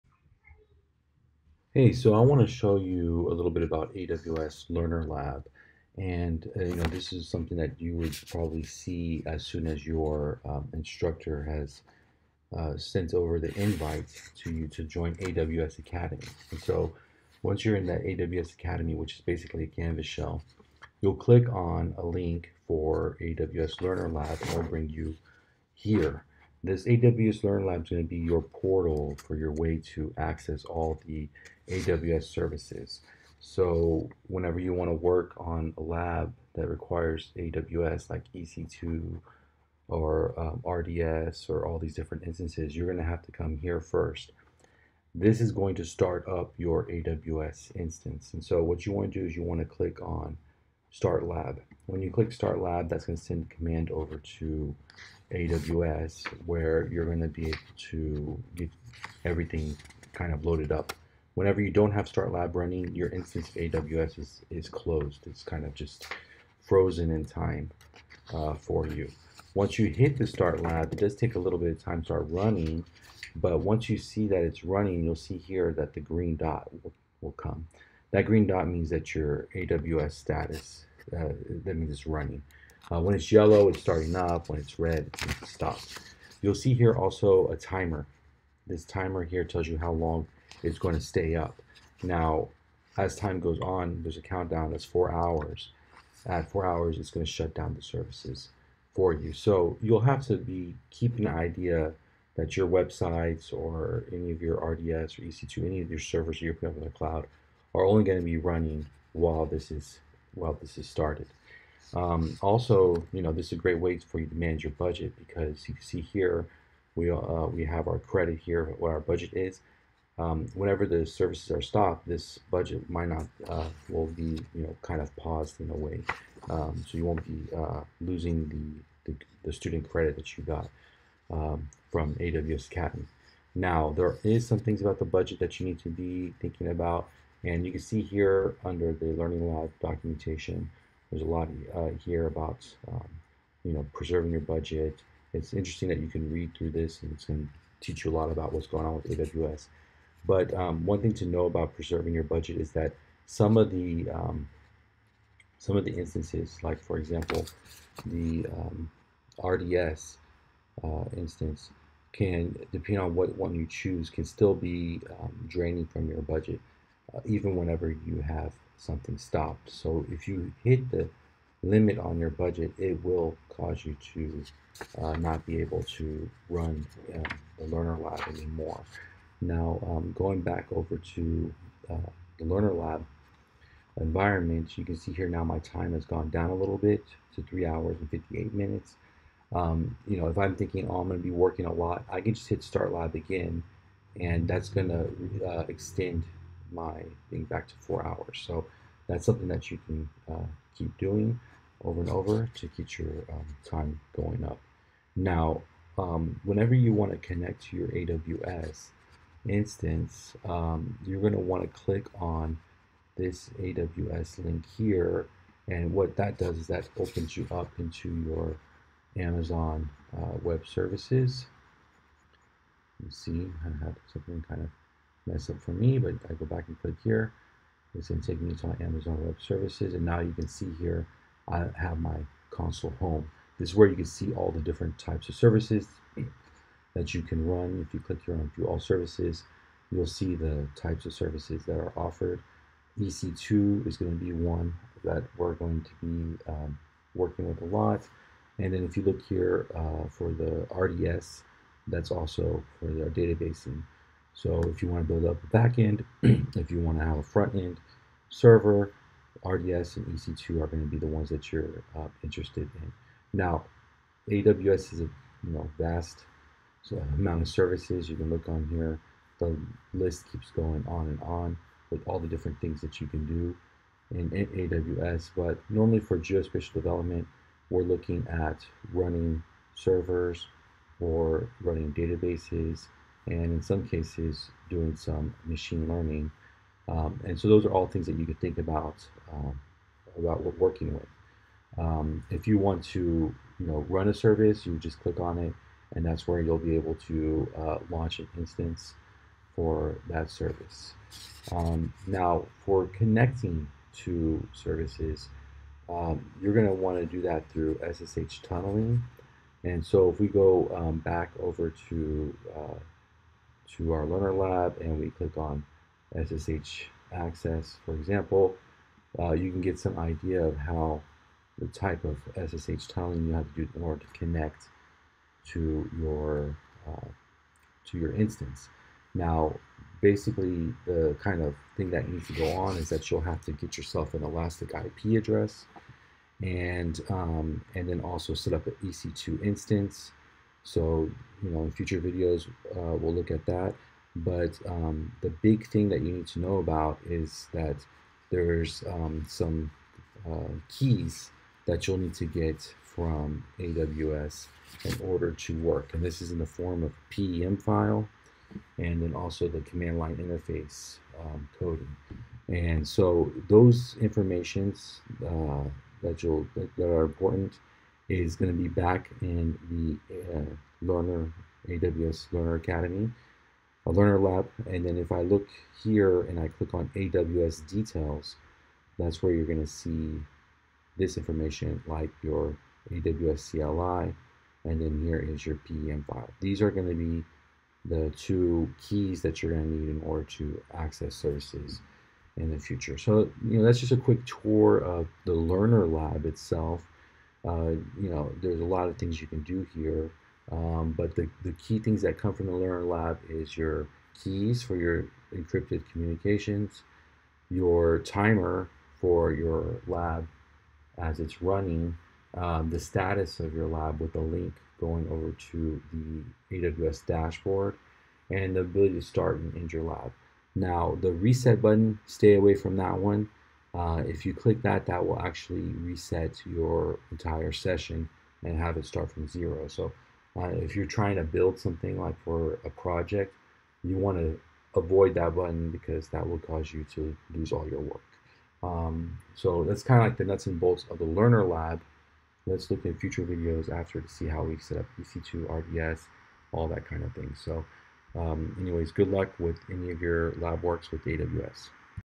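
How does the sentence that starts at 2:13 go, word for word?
Now there is some things about the budget that you need to be thinking about.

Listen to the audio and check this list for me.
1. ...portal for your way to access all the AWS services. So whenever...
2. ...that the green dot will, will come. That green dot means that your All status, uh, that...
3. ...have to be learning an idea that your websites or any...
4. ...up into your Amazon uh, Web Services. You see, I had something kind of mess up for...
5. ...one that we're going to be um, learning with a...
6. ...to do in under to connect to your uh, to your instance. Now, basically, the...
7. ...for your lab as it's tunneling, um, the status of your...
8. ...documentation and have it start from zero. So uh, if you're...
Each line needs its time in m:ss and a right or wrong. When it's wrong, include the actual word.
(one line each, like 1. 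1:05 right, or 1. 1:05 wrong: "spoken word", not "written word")
1. 0:28 right
2. 1:15 wrong: "AWS", not "All"
3. 1:40 wrong: "keeping", not "learning"
4. 3:37 right
5. 4:04 wrong: "working", not "learning"
6. 5:23 wrong: "order", not "under"
7. 6:48 wrong: "running", not "tunneling"
8. 7:07 wrong: "session", not "documentation".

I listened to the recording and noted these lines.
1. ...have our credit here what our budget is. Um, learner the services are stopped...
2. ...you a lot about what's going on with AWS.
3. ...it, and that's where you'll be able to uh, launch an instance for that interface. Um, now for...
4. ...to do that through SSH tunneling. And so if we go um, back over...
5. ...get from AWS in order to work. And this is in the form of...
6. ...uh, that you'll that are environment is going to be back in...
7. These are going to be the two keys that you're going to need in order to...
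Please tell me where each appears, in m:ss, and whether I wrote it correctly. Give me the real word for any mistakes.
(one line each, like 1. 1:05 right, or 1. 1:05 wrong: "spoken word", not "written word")
1. 1:57 wrong: "whenever", not "learner"
2. 2:28 right
3. 4:55 wrong: "service", not "interface"
4. 5:06 right
5. 5:52 right
6. 6:05 wrong: "important", not "environment"
7. 6:26 right.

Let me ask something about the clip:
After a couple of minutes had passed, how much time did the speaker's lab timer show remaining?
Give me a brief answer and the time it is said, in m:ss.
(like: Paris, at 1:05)
3 hours 58 minutes, at 3:07.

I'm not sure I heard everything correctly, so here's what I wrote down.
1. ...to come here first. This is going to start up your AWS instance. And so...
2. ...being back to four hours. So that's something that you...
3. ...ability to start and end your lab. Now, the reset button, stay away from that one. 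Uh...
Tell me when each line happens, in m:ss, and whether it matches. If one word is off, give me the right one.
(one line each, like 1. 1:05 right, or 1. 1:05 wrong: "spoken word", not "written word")
1. 0:43 right
2. 3:17 right
3. 6:58 right.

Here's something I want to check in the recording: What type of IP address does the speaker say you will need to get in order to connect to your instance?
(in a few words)
Elastic IP address.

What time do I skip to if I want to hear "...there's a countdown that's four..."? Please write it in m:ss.
1:34.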